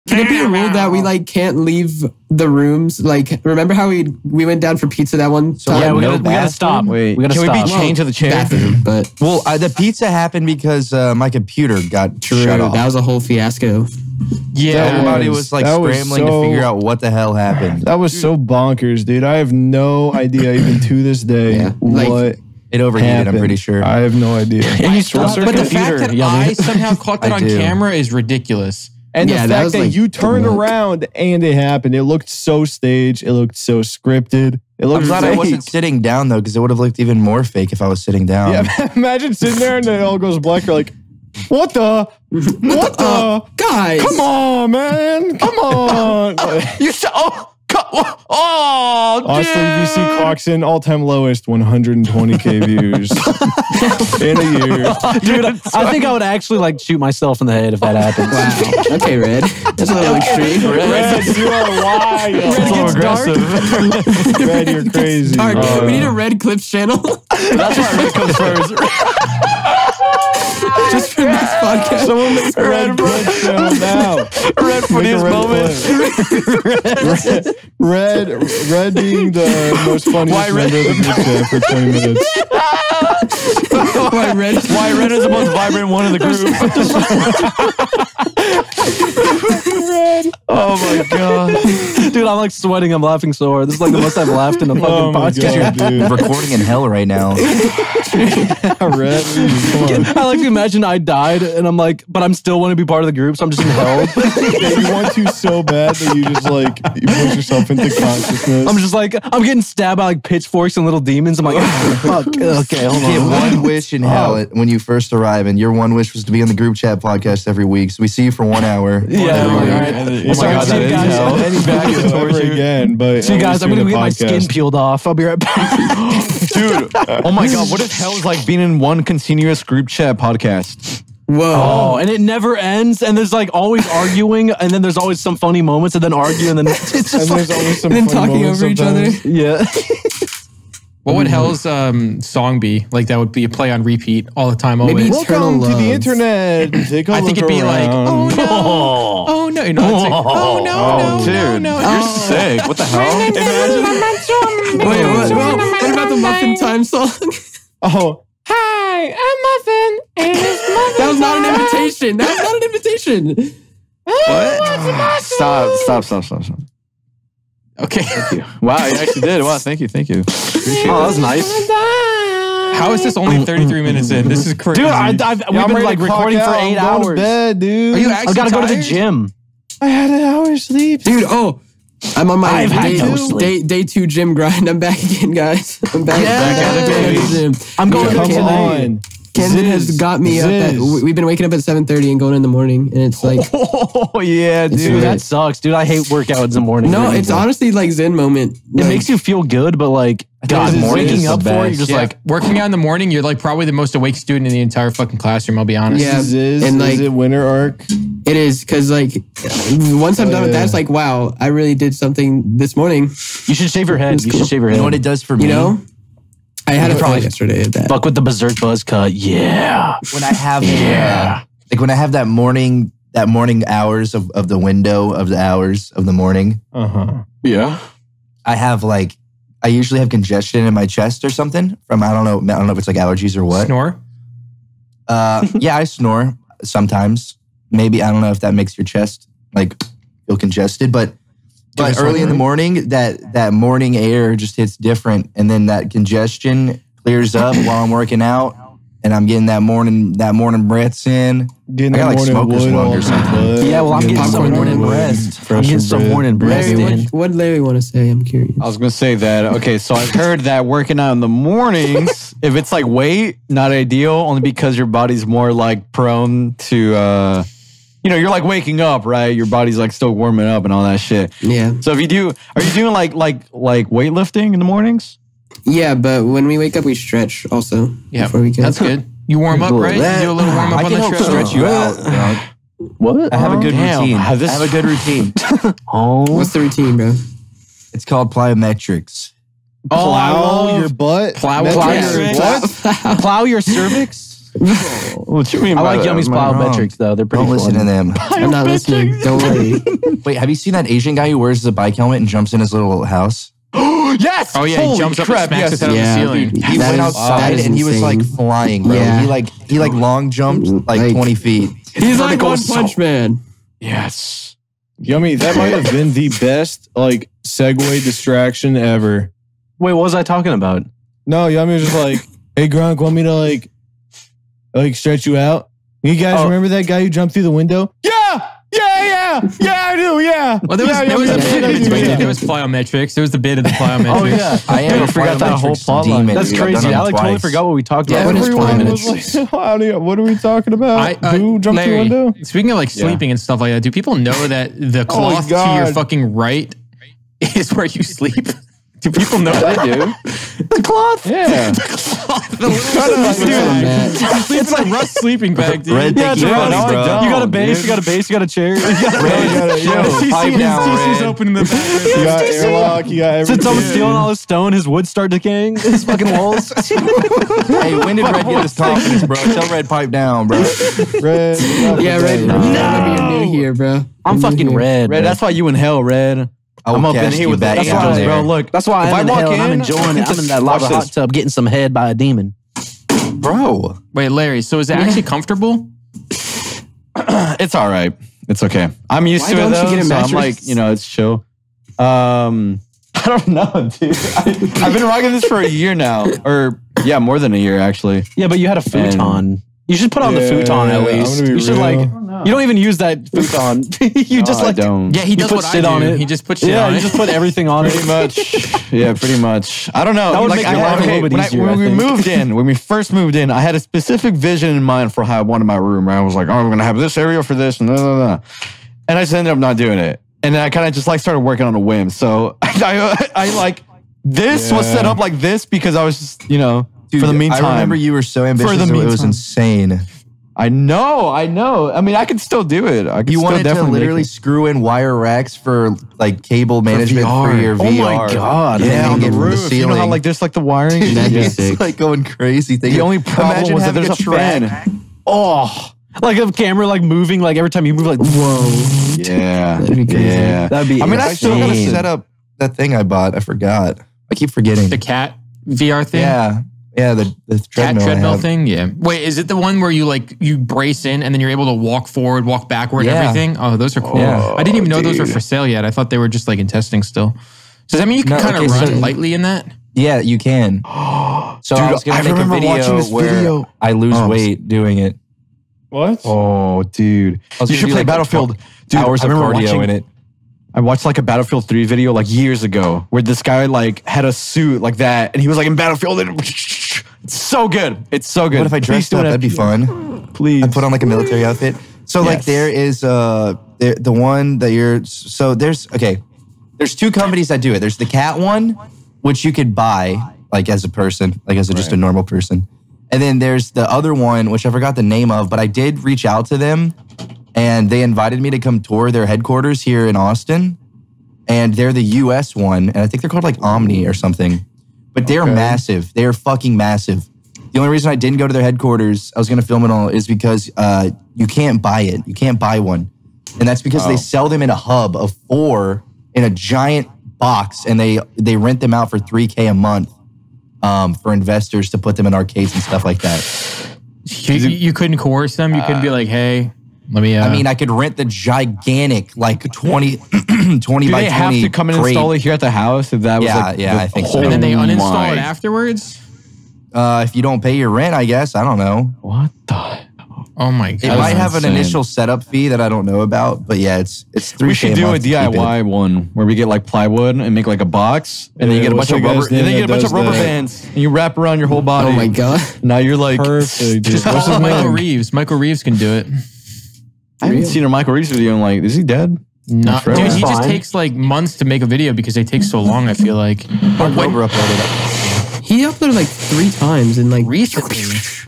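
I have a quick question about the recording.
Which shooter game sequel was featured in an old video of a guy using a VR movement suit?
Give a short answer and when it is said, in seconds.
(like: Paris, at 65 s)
Battlefield 3, at 481 s.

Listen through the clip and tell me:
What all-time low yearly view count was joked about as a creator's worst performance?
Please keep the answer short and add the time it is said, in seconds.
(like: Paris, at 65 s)
120k, at 51 s.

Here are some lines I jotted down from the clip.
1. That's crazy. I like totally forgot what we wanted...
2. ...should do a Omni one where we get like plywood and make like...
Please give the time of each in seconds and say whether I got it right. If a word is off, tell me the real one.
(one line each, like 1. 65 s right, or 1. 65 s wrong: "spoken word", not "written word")
1. 336 s wrong: "talked", not "wanted"
2. 554 s wrong: "DIY", not "Omni".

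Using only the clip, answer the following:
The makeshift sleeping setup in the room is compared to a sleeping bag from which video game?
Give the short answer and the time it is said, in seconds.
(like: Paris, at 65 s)
Rust, at 354 s.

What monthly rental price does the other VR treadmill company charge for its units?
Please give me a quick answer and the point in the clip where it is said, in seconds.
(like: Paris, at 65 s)
3k, at 529 s.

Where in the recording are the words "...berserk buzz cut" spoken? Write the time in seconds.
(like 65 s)
218 s.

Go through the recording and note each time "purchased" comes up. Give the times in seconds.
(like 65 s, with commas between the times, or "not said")
not said.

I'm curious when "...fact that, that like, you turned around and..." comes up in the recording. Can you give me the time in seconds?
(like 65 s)
29 s.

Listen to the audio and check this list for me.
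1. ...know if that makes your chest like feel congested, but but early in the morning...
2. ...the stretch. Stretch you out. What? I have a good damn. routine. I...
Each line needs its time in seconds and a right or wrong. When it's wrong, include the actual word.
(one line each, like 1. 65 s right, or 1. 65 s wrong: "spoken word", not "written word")
1. 238 s right
2. 280 s right.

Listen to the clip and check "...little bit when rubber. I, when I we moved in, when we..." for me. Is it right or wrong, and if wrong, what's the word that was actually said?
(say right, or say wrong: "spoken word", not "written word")
wrong: "easier", not "rubber".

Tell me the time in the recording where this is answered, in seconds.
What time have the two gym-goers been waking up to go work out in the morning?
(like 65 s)
191 s.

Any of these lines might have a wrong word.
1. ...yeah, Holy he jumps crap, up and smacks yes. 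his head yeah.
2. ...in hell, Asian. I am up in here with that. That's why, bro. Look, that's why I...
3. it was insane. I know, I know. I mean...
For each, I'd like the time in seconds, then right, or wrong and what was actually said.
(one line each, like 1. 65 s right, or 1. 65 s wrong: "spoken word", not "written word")
1. 304 s right
2. 375 s wrong: "Red", not "Asian"
3. 429 s right.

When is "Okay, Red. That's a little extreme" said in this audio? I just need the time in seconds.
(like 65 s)
58 s.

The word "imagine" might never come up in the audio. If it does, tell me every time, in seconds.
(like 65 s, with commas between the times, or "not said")
38 s, 100 s, 153 s, 443 s.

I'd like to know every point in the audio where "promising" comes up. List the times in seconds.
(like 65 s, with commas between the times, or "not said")
not said.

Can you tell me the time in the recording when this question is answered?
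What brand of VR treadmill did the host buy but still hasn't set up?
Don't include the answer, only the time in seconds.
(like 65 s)
454 s.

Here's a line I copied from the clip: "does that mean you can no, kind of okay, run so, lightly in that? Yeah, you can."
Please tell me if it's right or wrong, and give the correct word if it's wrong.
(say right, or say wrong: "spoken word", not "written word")
right.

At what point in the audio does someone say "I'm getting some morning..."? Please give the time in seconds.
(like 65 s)
255 s.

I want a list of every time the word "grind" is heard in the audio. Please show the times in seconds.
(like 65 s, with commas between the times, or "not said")
184 s.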